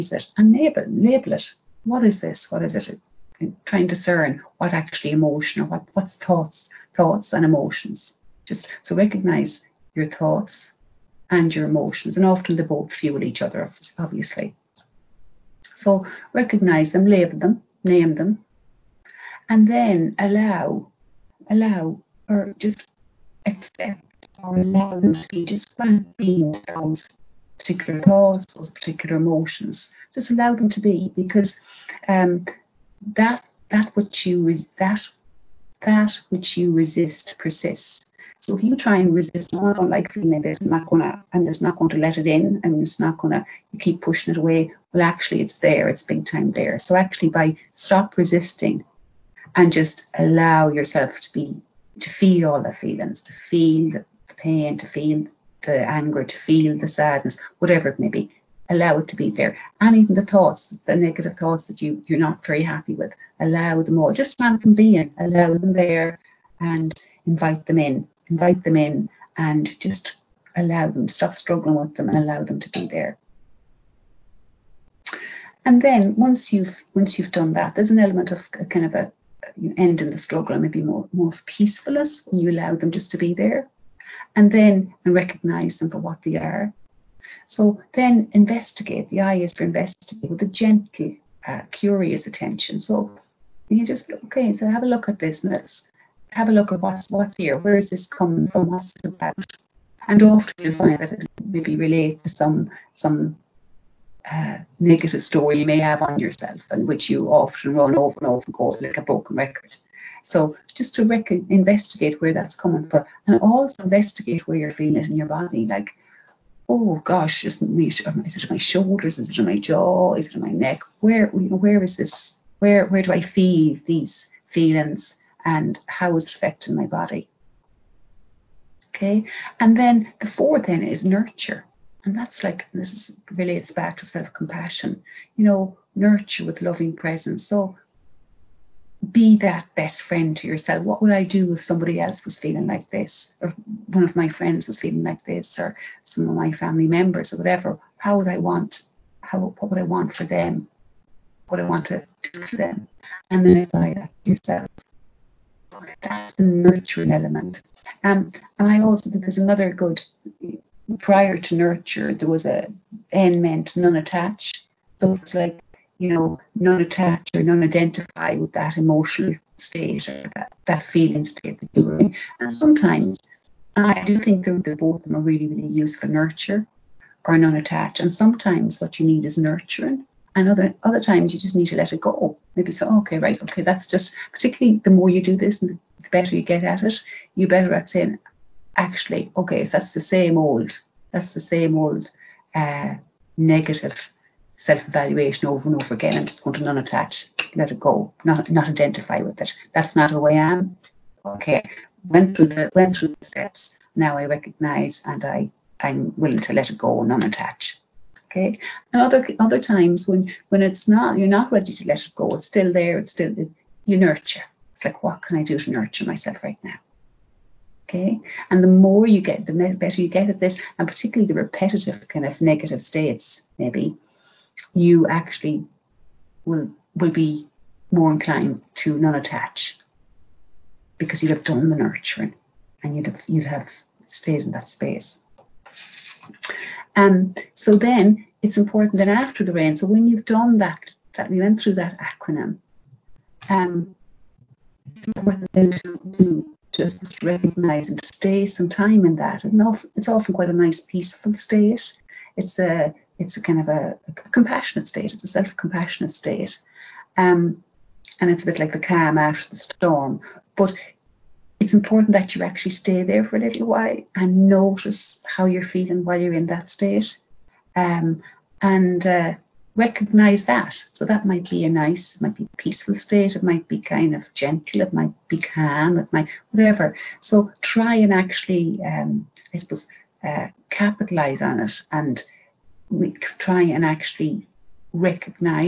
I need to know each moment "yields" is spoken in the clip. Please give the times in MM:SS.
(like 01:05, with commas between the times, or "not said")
not said.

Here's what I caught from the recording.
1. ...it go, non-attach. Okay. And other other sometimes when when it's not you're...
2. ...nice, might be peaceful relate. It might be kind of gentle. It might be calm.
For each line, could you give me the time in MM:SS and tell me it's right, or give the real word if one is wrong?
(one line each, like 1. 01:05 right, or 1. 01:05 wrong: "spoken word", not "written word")
1. 03:26 wrong: "times", not "sometimes"
2. 04:31 wrong: "state", not "relate".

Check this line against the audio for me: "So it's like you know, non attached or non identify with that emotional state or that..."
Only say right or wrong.
right.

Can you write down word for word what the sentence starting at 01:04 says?
Just let them be in, allow them there and invite them in.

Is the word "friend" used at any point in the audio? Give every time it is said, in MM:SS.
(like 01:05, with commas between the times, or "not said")
02:20, 02:24.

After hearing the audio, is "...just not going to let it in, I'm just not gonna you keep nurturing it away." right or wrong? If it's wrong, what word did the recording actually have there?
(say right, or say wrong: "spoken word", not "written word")
wrong: "pushing", not "nurturing".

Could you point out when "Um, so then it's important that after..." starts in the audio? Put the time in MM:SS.
03:56.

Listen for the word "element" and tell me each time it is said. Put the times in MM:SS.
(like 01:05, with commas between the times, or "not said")
01:17, 02:37.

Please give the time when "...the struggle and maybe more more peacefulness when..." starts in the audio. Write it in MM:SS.
01:20.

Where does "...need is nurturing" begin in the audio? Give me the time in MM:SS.
02:59.